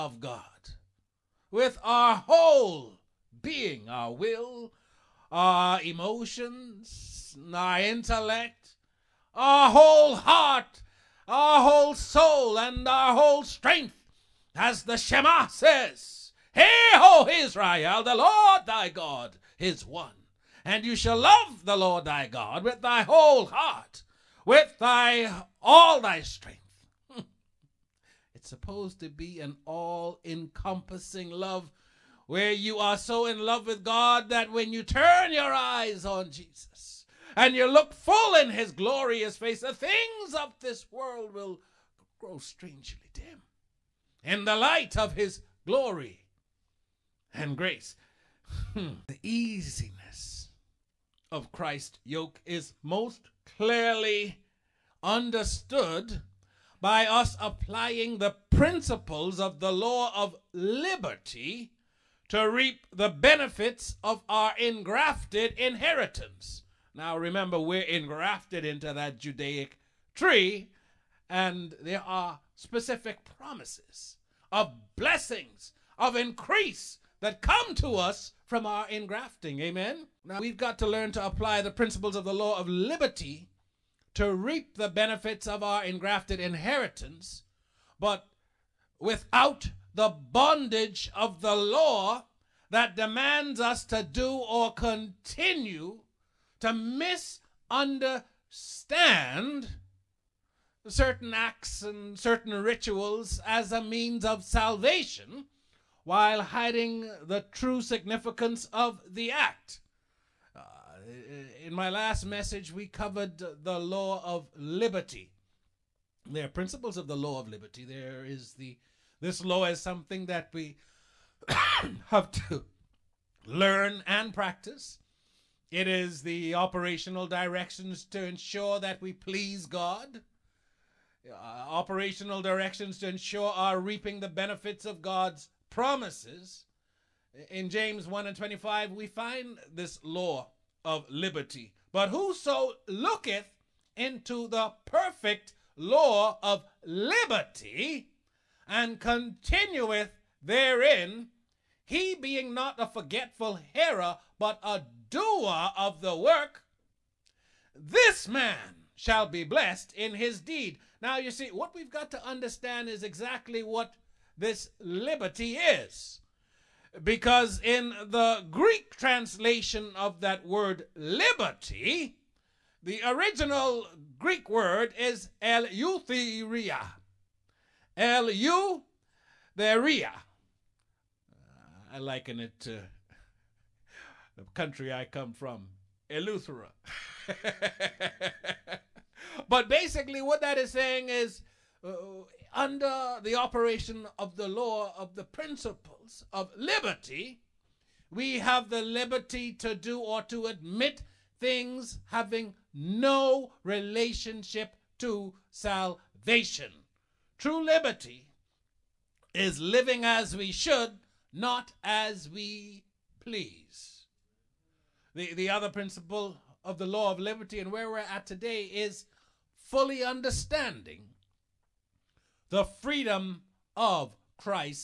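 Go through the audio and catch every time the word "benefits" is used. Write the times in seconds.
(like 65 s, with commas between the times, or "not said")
63 s, 84 s, 134 s.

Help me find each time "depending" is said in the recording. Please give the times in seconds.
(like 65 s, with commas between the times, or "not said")
not said.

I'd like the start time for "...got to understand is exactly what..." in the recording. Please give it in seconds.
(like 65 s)
161 s.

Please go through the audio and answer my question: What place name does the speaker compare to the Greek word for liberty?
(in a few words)
Eleuthera.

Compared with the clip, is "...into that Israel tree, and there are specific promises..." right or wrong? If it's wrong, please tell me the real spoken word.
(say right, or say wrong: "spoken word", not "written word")
wrong: "Judaic", not "Israel".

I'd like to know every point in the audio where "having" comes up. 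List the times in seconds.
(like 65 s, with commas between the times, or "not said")
202 s.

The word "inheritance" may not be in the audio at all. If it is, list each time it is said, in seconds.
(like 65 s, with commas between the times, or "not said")
65 s, 86 s.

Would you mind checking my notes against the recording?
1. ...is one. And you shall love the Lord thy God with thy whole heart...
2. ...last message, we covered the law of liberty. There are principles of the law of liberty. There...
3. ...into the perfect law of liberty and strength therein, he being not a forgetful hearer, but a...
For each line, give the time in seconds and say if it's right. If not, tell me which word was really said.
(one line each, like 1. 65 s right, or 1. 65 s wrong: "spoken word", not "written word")
1. 19 s right
2. 111 s right
3. 143 s wrong: "continueth", not "strength".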